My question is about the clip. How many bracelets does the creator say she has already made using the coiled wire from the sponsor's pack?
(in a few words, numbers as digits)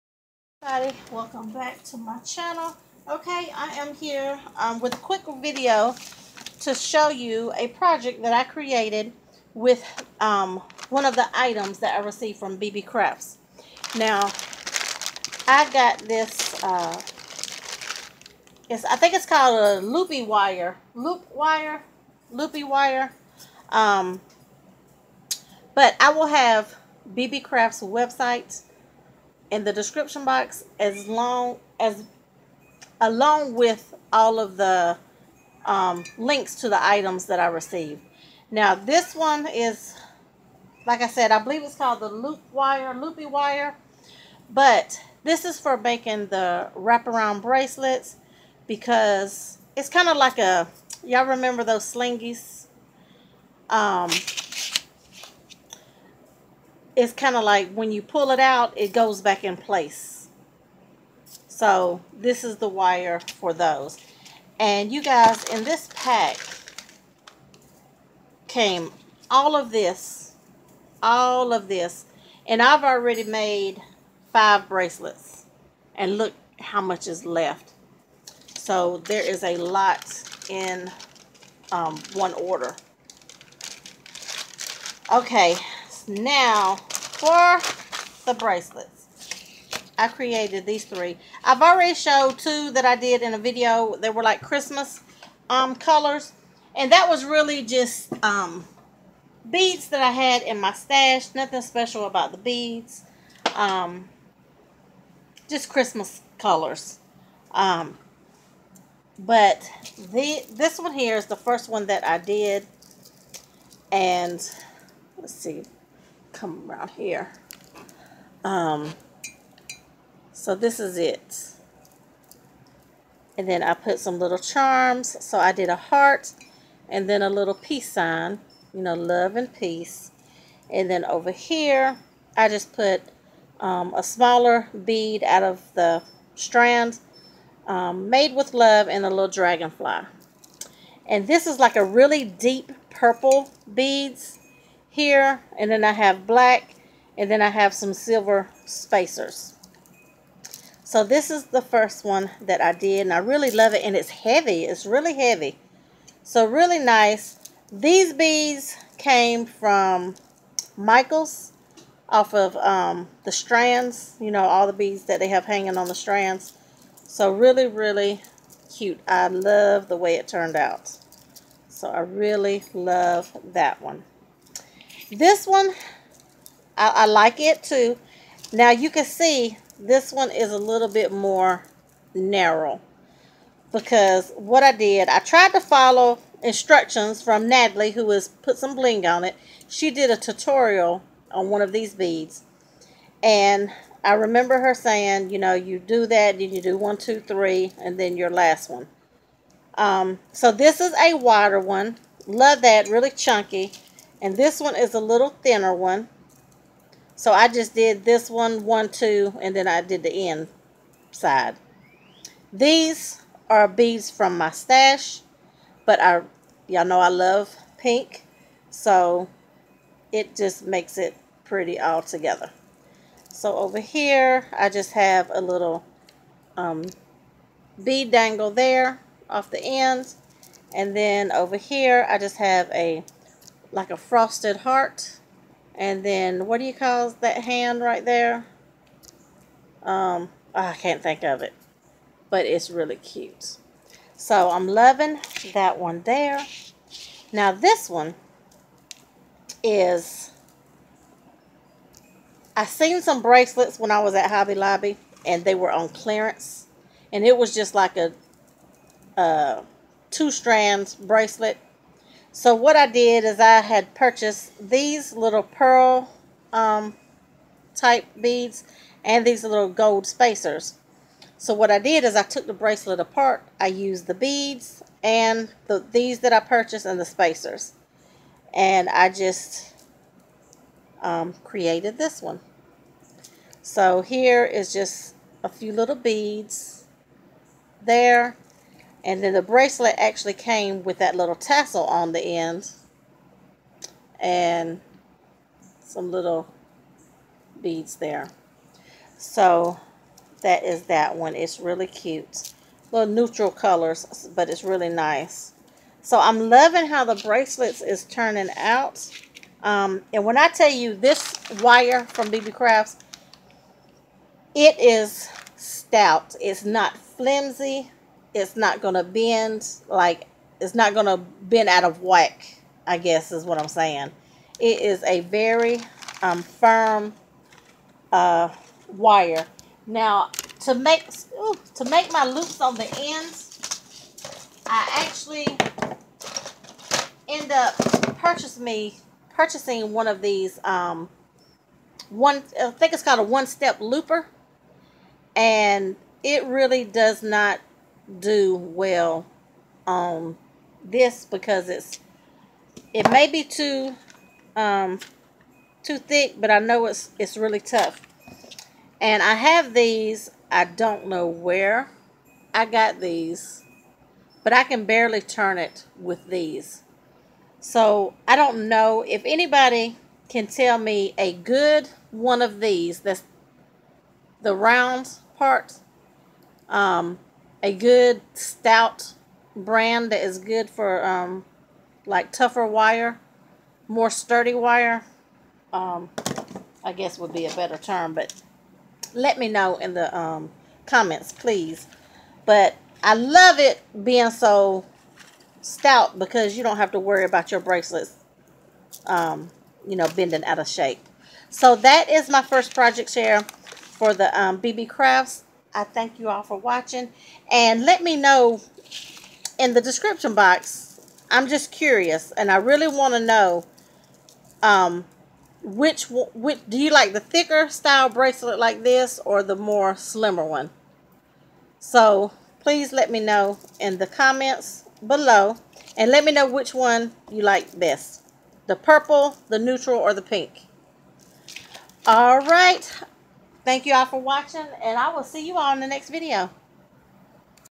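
5.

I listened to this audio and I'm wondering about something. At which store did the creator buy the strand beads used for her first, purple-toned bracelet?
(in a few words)
Michaels.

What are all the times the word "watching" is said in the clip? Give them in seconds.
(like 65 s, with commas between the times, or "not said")
406 s, 434 s.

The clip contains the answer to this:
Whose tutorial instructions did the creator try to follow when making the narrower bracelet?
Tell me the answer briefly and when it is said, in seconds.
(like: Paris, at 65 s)
Natalie, at 187 s.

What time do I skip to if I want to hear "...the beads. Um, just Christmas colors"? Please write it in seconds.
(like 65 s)
102 s.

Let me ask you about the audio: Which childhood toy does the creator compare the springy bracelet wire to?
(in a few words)
Slinkies.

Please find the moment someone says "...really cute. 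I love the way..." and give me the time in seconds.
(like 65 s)
167 s.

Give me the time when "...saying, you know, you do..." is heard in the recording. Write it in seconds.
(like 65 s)
194 s.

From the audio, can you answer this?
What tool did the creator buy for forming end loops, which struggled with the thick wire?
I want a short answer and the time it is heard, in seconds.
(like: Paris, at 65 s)
one step looper, at 343 s.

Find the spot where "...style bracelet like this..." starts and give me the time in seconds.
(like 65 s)
417 s.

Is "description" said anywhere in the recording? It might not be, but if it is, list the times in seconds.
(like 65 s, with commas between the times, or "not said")
29 s, 409 s.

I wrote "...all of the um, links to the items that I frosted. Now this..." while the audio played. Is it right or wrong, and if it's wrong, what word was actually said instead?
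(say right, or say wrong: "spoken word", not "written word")
wrong: "received", not "frosted".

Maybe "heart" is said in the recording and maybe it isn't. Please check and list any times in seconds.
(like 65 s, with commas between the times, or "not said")
125 s, 234 s.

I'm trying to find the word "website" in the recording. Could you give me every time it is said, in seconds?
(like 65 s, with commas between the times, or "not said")
27 s.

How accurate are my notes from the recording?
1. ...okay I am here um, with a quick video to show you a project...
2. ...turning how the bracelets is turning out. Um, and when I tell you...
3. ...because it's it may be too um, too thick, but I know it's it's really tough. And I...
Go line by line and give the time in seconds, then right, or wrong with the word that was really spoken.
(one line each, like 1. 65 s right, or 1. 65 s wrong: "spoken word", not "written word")
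1. 3 s right
2. 306 s wrong: "loving", not "turning"
3. 351 s right.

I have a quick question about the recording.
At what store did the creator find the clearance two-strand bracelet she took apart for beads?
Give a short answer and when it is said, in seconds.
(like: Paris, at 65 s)
Hobby Lobby, at 254 s.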